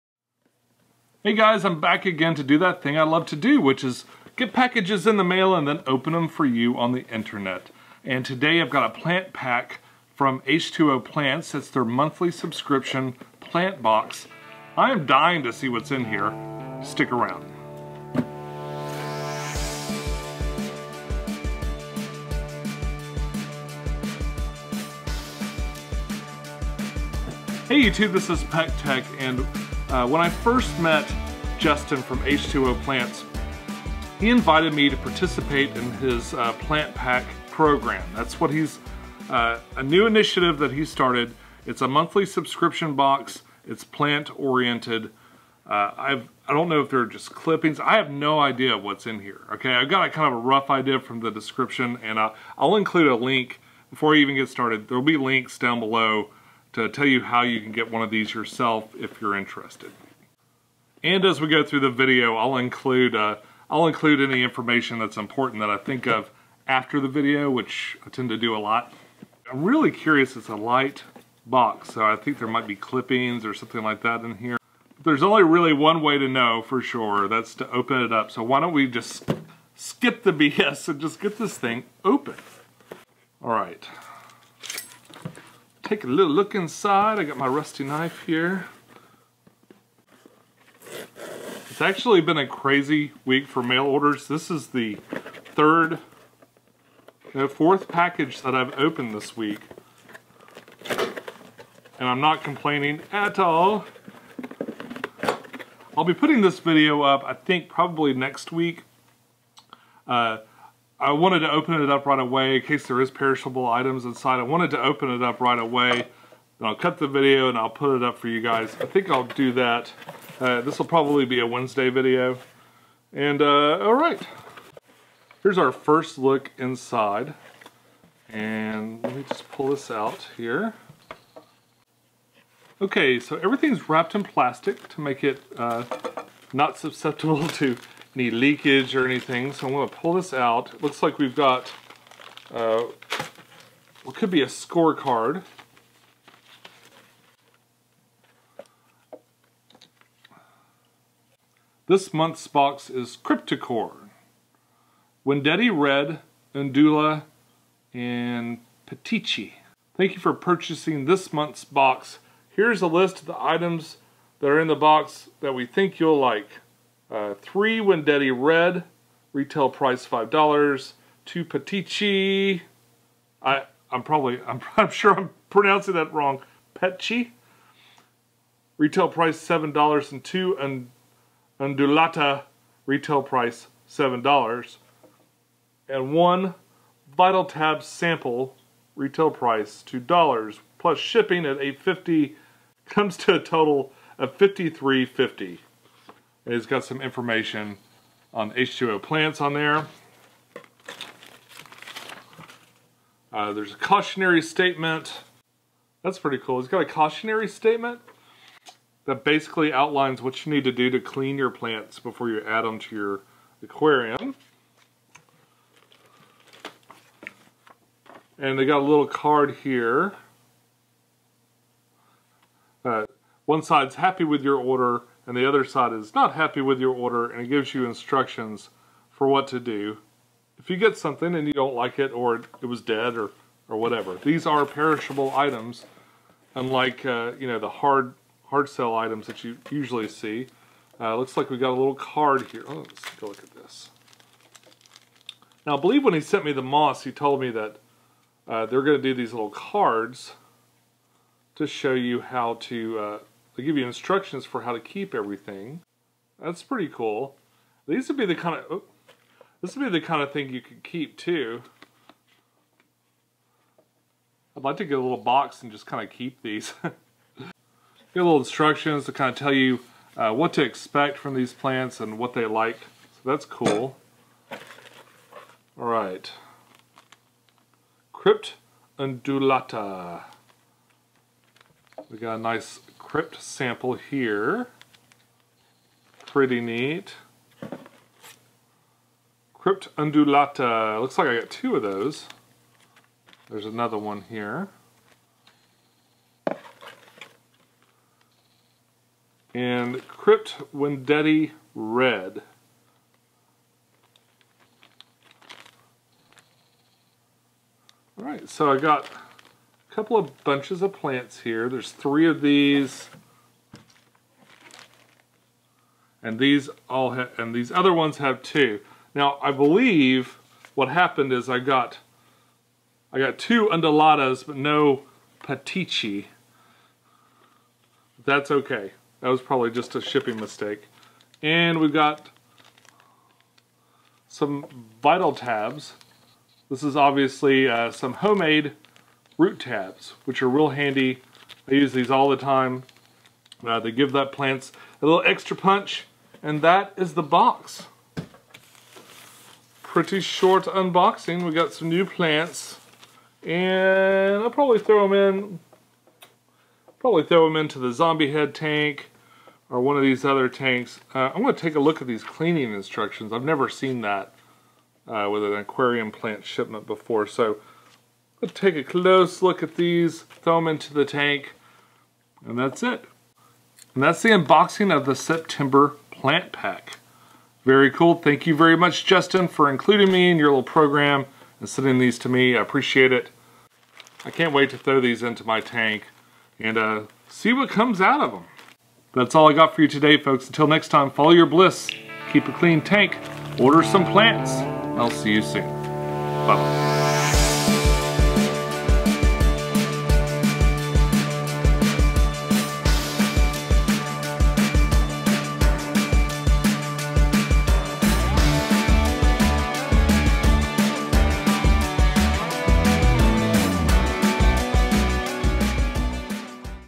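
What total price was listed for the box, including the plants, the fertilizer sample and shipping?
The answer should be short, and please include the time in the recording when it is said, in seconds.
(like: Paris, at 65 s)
$53.50, at 194 s.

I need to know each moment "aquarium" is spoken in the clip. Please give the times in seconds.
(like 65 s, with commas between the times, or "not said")
213 s, 365 s.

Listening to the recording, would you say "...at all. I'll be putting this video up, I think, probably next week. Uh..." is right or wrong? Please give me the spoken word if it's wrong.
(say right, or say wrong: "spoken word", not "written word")
right.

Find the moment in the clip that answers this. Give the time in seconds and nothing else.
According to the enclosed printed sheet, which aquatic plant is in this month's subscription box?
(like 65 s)
153 s.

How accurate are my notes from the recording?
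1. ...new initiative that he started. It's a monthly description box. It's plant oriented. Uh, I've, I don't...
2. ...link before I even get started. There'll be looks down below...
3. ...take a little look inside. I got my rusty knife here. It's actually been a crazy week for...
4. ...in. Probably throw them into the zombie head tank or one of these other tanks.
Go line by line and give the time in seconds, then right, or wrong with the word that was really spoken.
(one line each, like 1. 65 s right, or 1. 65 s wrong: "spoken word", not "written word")
1. 39 s wrong: "subscription", not "description"
2. 53 s wrong: "links", not "looks"
3. 85 s right
4. 355 s right.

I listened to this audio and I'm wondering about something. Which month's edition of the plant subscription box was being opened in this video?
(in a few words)
September.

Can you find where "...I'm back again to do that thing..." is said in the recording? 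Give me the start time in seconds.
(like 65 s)
1 s.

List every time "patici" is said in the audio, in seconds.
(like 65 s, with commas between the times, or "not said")
325 s.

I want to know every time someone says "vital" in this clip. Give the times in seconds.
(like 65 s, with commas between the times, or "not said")
187 s, 335 s.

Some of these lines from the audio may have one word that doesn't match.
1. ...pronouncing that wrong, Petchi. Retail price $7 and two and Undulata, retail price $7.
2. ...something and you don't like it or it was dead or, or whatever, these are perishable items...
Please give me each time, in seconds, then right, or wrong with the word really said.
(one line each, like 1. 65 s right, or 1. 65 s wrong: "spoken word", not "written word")
1. 175 s right
2. 230 s right.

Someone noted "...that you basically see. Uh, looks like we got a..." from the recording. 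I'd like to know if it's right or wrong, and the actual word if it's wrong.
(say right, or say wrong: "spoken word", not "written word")
wrong: "usually", not "basically".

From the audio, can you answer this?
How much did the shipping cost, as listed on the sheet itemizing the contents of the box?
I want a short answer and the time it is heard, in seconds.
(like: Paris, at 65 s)
$8.50, at 191 s.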